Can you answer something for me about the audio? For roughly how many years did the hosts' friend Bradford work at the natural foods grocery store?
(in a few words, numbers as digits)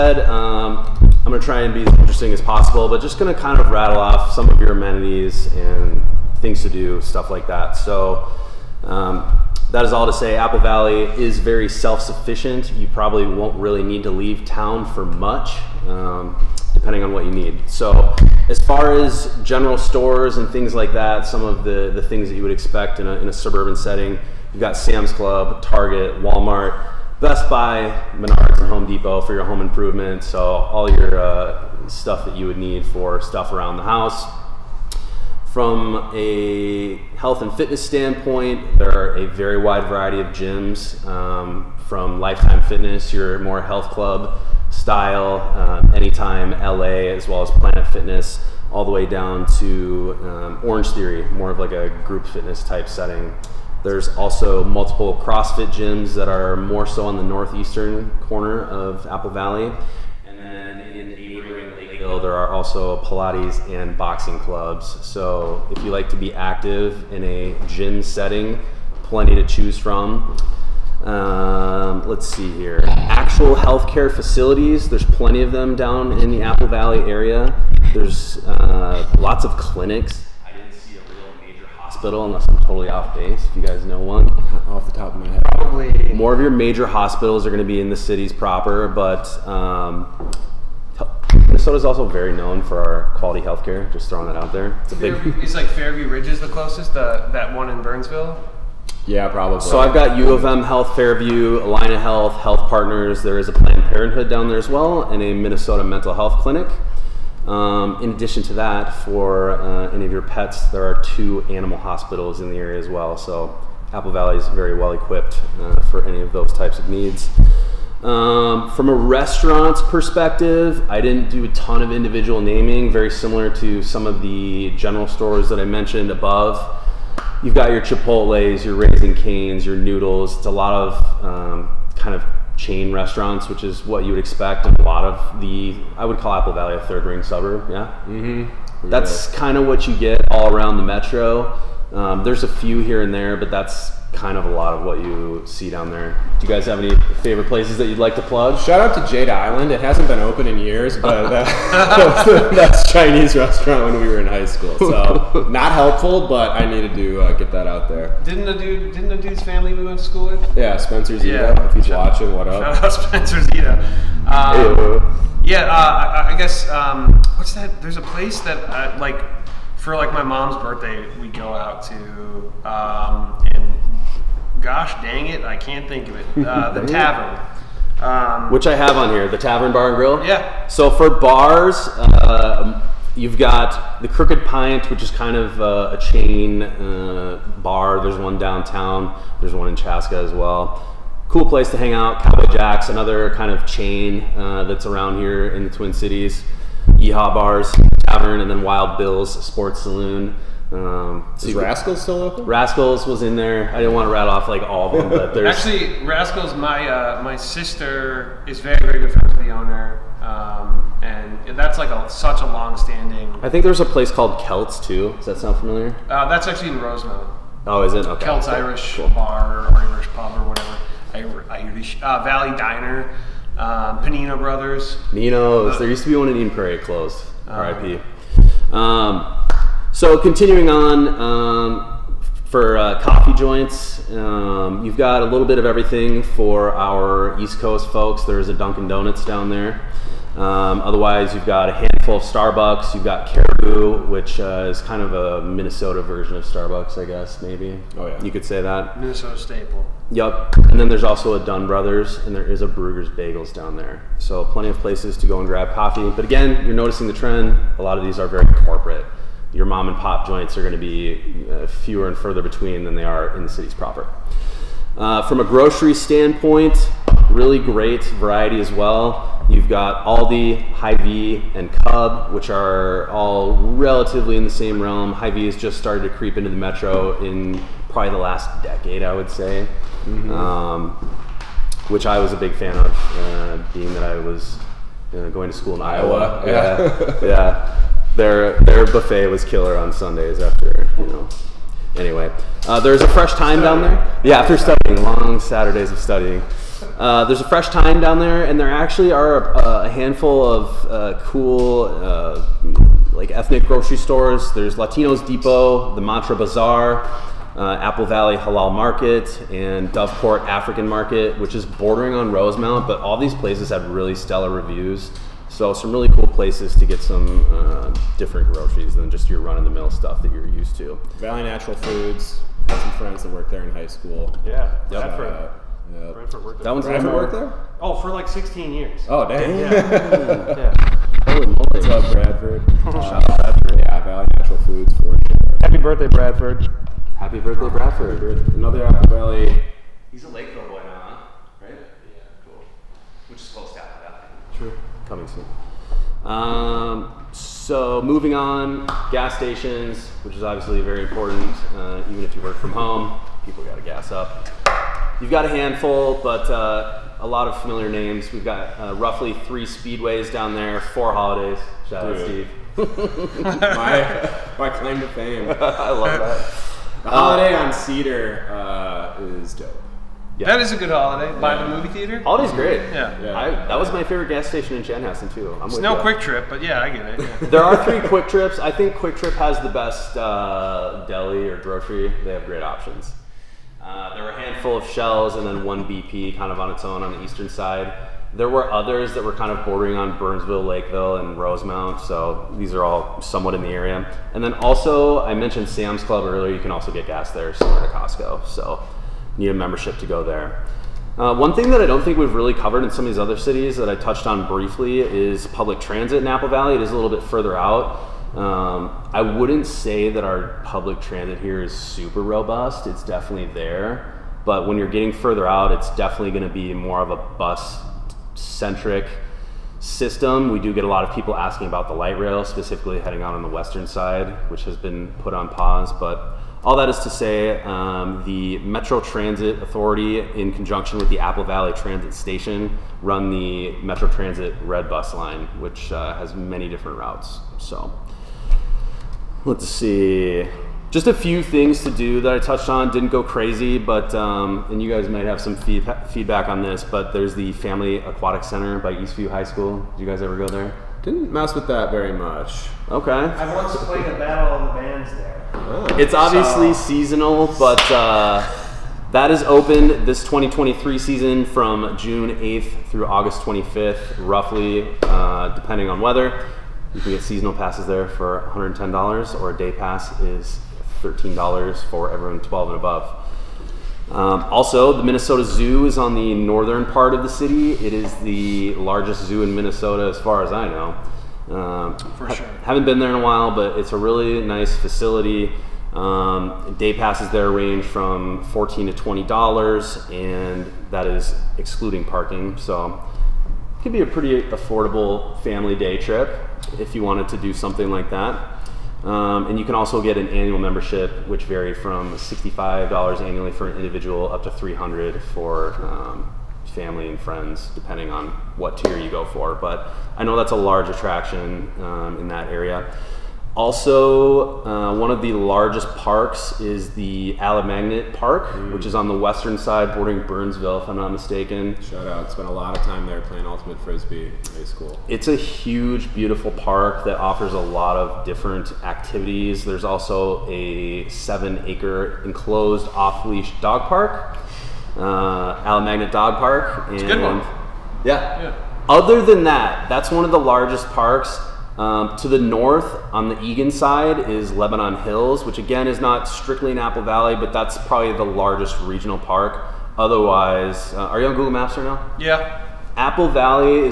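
16.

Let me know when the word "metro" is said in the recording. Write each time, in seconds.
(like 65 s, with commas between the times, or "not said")
140 s, 276 s, 428 s, 433 s.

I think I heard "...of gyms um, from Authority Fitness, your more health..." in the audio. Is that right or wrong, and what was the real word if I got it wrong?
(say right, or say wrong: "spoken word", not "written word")
wrong: "Lifetime", not "Authority".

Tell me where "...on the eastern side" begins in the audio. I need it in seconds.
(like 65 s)
387 s.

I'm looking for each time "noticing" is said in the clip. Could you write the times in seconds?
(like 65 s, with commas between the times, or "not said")
256 s.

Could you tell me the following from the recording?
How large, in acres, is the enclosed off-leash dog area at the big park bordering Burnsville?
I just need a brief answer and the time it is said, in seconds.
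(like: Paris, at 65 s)
7 acres, at 531 s.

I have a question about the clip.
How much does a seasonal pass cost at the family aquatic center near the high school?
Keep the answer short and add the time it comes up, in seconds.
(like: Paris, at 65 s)
$110, at 468 s.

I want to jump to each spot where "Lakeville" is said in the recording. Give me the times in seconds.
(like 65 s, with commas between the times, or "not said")
340 s, 390 s.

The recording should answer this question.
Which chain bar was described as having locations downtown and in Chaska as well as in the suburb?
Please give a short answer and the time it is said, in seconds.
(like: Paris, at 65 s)
Crooked Pint, at 184 s.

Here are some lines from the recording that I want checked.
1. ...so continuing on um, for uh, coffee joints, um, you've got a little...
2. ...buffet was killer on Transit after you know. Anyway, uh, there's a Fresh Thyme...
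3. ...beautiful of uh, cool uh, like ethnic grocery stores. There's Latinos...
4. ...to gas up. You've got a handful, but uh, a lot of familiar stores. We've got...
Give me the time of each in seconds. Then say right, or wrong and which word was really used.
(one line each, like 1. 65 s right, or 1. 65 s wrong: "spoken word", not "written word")
1. 229 s right
2. 288 s wrong: "Sundays", not "Transit"
3. 299 s wrong: "handful", not "beautiful"
4. 353 s wrong: "names", not "stores".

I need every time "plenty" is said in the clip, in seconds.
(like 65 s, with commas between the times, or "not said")
69 s, 75 s, 254 s.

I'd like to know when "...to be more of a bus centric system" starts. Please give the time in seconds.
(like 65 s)
416 s.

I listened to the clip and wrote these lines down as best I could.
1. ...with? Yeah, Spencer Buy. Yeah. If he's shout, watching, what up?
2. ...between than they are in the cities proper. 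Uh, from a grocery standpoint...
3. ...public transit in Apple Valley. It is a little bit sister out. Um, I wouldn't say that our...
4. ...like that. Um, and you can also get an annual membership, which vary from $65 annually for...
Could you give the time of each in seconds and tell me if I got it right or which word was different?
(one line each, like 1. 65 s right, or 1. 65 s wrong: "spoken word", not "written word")
1. 160 s wrong: "Zito", not "Buy"
2. 262 s right
3. 405 s wrong: "further", not "sister"
4. 497 s right.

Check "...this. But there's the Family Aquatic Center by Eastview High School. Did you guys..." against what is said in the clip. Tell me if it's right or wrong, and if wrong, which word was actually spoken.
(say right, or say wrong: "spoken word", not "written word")
right.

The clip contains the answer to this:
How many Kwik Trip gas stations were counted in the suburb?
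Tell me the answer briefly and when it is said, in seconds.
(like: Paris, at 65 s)
3, at 377 s.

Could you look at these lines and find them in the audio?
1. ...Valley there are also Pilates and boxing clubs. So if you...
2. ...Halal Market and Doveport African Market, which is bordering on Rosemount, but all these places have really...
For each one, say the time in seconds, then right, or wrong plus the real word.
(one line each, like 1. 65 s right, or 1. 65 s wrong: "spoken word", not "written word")
1. 59 s right
2. 308 s right.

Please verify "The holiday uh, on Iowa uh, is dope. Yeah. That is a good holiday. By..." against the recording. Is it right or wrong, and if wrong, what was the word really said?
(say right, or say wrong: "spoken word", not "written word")
wrong: "Cedar", not "Iowa".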